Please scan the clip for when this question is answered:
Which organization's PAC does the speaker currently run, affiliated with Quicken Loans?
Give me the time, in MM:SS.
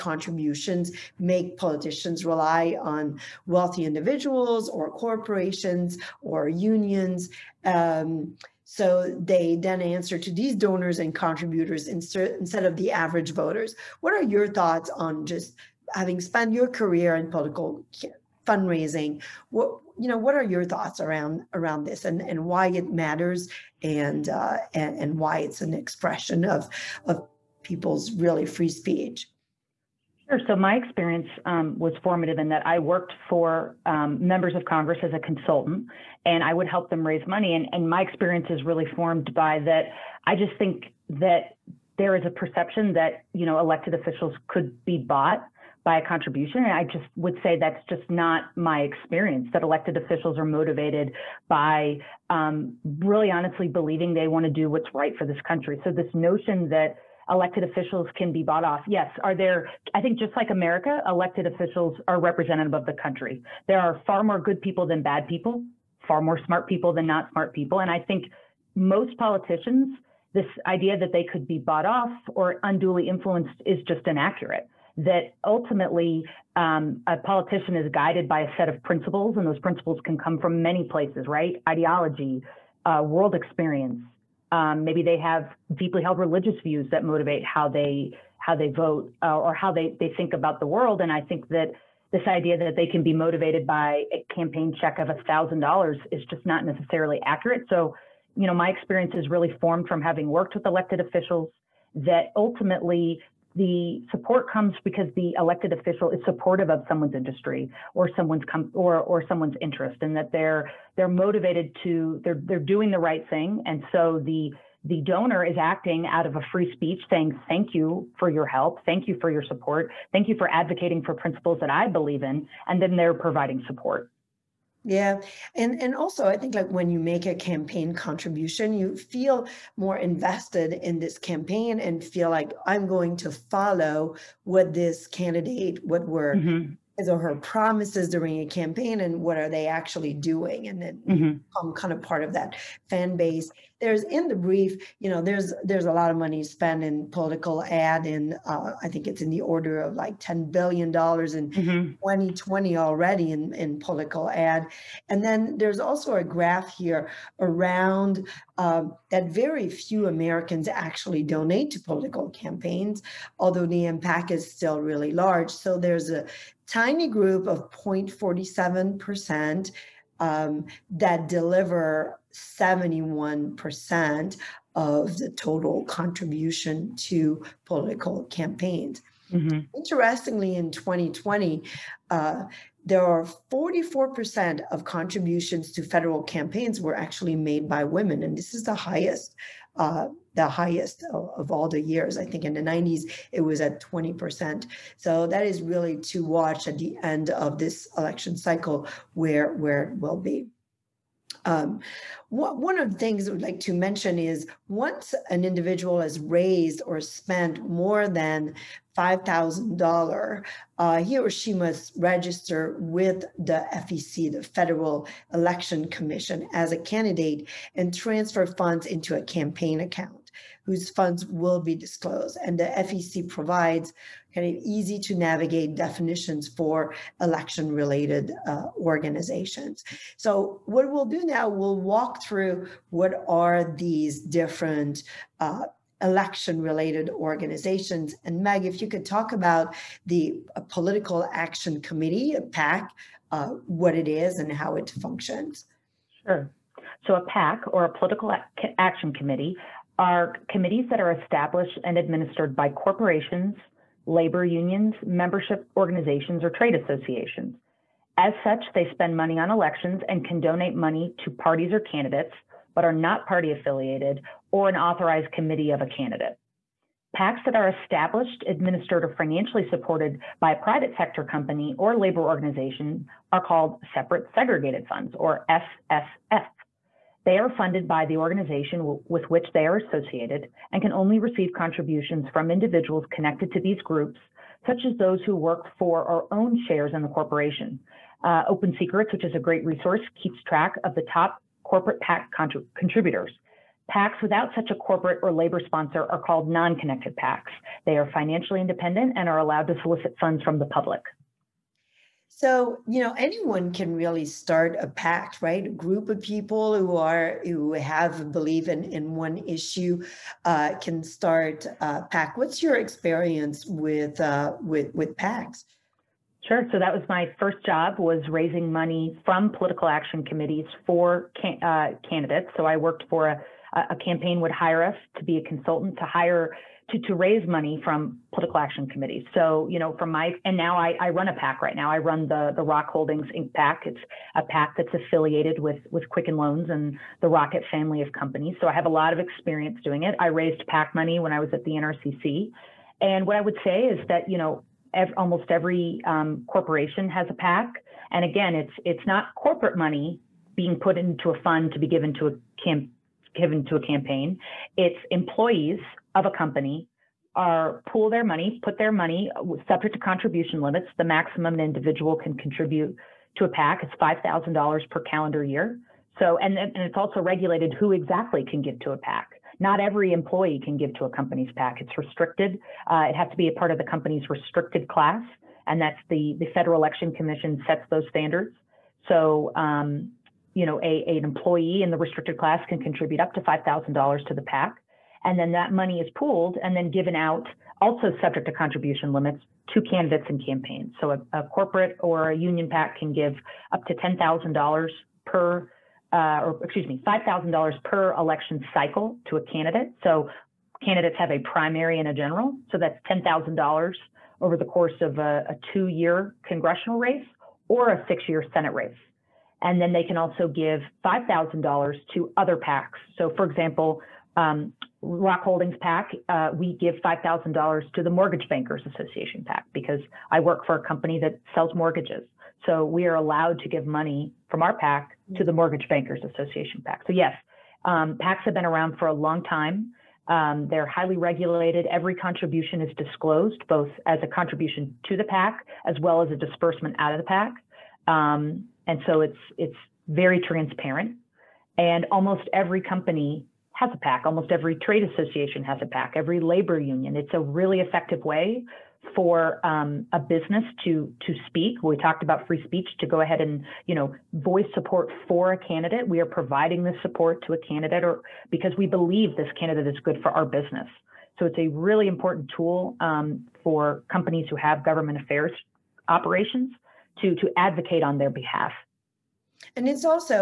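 05:32.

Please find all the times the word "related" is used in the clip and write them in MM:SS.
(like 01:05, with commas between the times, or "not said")
03:47, 03:56.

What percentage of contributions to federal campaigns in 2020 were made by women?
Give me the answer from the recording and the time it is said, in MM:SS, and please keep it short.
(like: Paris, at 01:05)
44%, at 03:03.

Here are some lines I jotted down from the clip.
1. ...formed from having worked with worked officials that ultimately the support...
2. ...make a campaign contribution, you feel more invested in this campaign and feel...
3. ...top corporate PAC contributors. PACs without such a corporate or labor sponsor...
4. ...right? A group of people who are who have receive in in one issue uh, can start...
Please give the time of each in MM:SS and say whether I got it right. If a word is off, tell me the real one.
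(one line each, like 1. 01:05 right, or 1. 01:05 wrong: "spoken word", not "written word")
1. 01:39 wrong: "elected", not "worked"
2. 02:06 right
3. 04:51 right
4. 05:05 wrong: "believe", not "receive".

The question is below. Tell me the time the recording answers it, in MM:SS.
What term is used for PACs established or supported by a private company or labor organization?
04:33.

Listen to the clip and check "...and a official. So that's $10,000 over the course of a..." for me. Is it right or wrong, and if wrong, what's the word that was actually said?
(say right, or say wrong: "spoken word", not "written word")
wrong: "general", not "official".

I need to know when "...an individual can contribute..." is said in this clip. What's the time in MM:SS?
06:01.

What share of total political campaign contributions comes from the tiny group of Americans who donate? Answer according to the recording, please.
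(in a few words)
71%.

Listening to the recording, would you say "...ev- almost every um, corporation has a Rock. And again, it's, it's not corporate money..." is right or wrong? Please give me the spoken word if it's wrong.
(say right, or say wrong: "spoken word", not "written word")
wrong: "PAC", not "Rock".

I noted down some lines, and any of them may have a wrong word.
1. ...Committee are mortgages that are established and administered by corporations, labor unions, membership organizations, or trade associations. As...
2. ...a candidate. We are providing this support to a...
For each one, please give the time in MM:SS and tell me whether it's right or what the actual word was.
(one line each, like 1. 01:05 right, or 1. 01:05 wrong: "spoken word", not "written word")
1. 04:09 wrong: "committees", not "mortgages"
2. 07:35 right.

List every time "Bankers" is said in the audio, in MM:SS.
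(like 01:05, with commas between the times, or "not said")
06:58, 07:05.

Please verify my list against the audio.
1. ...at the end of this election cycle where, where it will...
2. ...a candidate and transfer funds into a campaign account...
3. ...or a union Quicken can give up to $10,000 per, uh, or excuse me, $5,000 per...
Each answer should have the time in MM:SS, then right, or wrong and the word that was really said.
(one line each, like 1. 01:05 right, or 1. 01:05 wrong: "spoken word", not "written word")
1. 03:16 right
2. 03:36 right
3. 06:32 wrong: "PAC", not "Quicken".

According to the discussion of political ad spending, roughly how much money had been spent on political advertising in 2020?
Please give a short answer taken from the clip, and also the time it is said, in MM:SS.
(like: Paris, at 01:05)
$10 billion, at 02:30.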